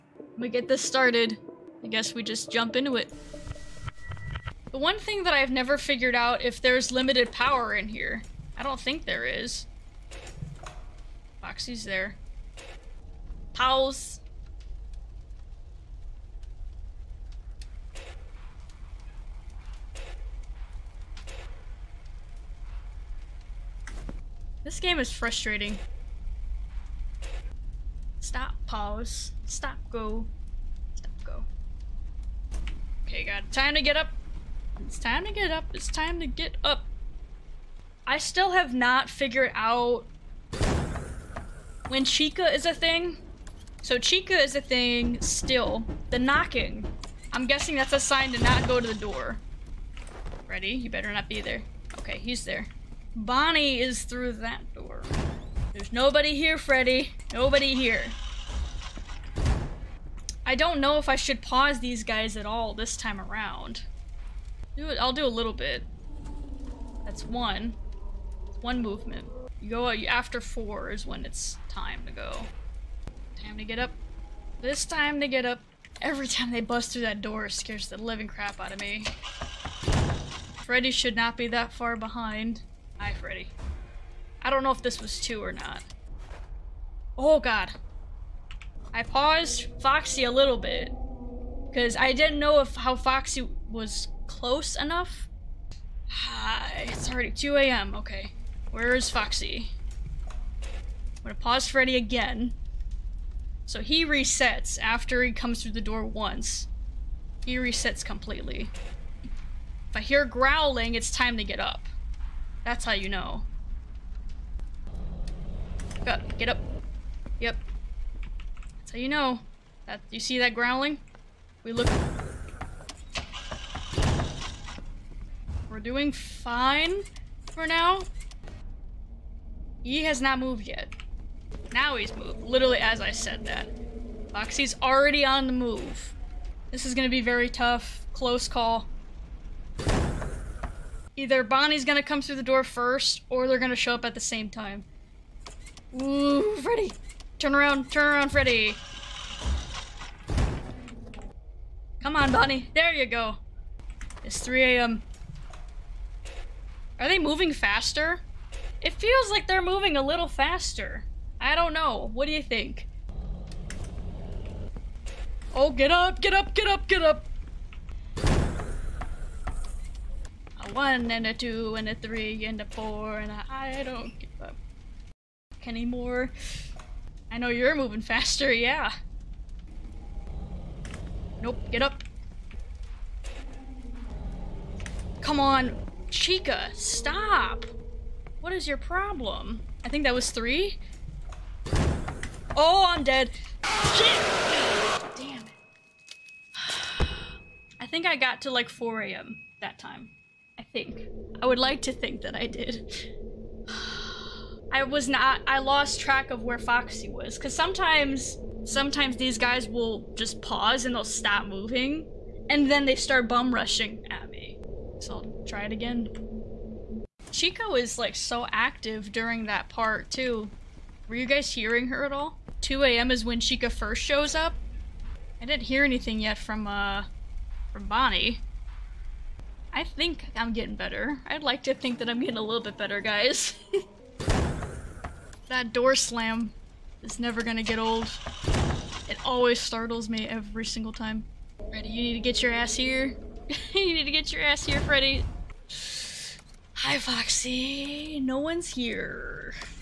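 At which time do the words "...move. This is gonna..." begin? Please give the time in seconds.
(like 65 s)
135 s.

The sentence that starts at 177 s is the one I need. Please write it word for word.
I know you're moving faster, yeah.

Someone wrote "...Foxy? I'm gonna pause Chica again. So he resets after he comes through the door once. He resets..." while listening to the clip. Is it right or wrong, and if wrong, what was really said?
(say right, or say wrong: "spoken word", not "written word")
wrong: "Freddy", not "Chica".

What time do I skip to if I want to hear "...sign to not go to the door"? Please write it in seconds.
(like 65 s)
47 s.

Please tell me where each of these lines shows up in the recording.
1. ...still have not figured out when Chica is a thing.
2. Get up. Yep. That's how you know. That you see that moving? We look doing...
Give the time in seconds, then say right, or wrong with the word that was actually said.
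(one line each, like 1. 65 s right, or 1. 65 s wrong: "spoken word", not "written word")
1. 38 s right
2. 116 s wrong: "growling", not "moving".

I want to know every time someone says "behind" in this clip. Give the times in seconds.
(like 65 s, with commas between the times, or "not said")
81 s.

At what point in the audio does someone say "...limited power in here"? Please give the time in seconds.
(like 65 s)
6 s.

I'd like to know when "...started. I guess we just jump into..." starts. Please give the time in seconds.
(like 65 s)
0 s.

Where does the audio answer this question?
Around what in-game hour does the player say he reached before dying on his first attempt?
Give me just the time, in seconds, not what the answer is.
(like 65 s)
198 s.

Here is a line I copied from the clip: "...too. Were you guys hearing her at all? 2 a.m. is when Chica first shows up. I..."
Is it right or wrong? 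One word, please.
right.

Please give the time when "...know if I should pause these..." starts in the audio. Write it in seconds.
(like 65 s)
60 s.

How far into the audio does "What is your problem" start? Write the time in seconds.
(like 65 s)
188 s.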